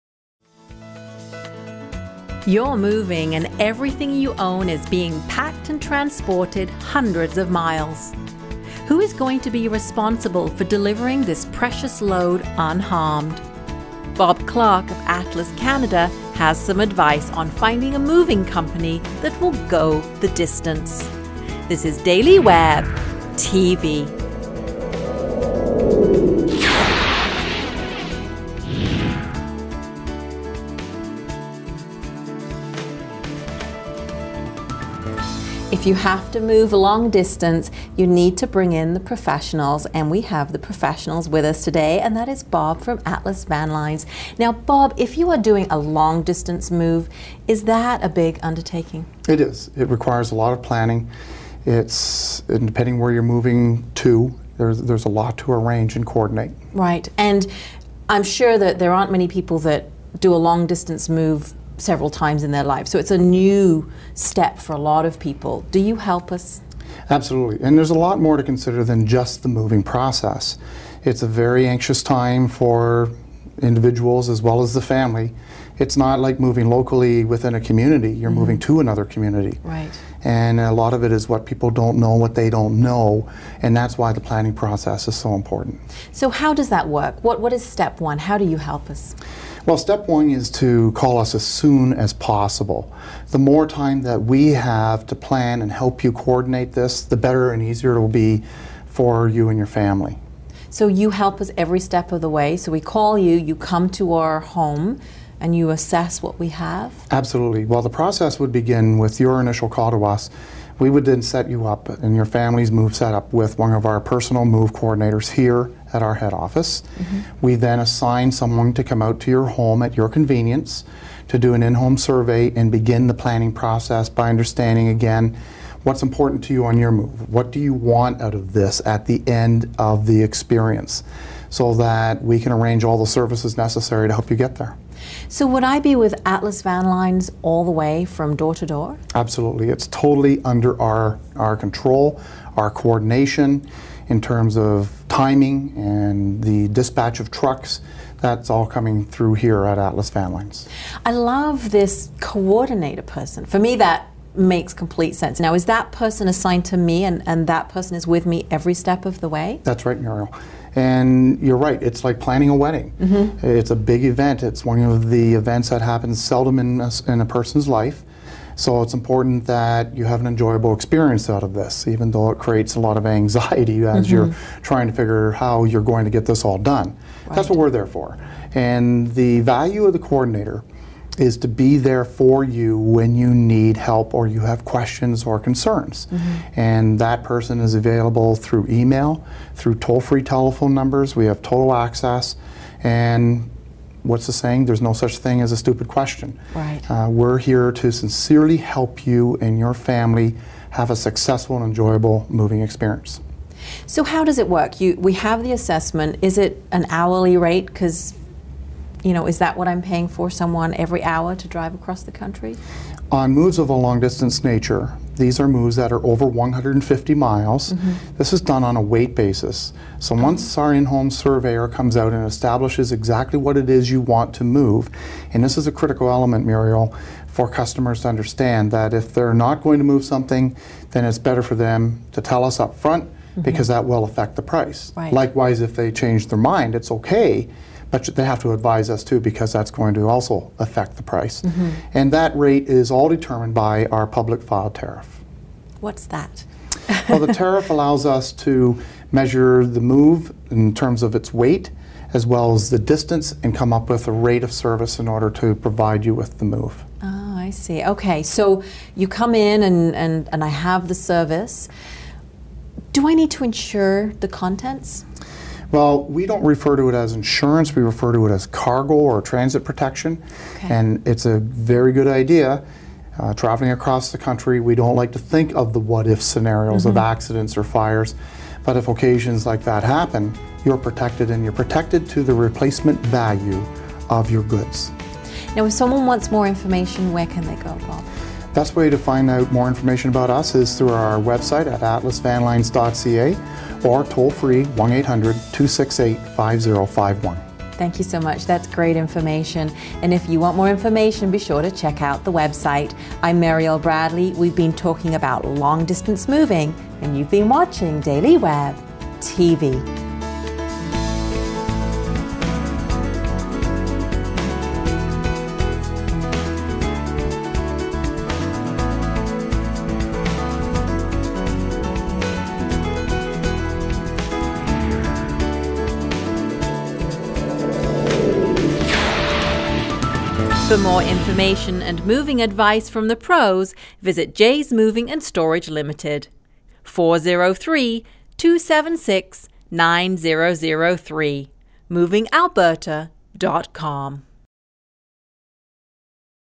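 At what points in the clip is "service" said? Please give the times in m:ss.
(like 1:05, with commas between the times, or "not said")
2:13, 4:14, 4:20.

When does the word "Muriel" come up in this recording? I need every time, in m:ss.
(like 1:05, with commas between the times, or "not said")
2:39, 3:46.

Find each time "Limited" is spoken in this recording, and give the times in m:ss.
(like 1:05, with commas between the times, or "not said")
5:35.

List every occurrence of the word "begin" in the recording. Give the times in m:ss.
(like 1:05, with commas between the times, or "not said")
1:48, 2:02.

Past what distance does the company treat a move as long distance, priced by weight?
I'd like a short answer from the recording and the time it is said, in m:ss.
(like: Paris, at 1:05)
150 miles, at 3:36.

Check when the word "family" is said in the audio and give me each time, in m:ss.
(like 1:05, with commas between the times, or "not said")
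1:14, 1:39, 1:52, 3:19.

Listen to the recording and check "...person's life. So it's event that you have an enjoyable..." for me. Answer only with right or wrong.
wrong.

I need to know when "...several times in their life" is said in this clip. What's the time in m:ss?
1:01.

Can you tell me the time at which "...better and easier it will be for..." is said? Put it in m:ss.
1:37.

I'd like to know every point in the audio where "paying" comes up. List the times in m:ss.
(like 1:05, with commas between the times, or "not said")
3:29.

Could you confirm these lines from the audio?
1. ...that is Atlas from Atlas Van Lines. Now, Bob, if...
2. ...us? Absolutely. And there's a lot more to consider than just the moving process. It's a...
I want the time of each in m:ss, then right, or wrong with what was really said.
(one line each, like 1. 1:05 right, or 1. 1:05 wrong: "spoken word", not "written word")
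1. 0:42 wrong: "Bob", not "Atlas"
2. 1:06 right.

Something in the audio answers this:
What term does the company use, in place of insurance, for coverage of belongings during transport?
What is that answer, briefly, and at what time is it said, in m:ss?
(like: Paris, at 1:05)
cargo or transit protection, at 4:28.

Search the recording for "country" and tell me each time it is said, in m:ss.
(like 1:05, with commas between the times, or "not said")
3:32, 4:34.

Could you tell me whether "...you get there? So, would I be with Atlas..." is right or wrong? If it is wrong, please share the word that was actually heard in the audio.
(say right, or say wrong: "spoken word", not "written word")
right.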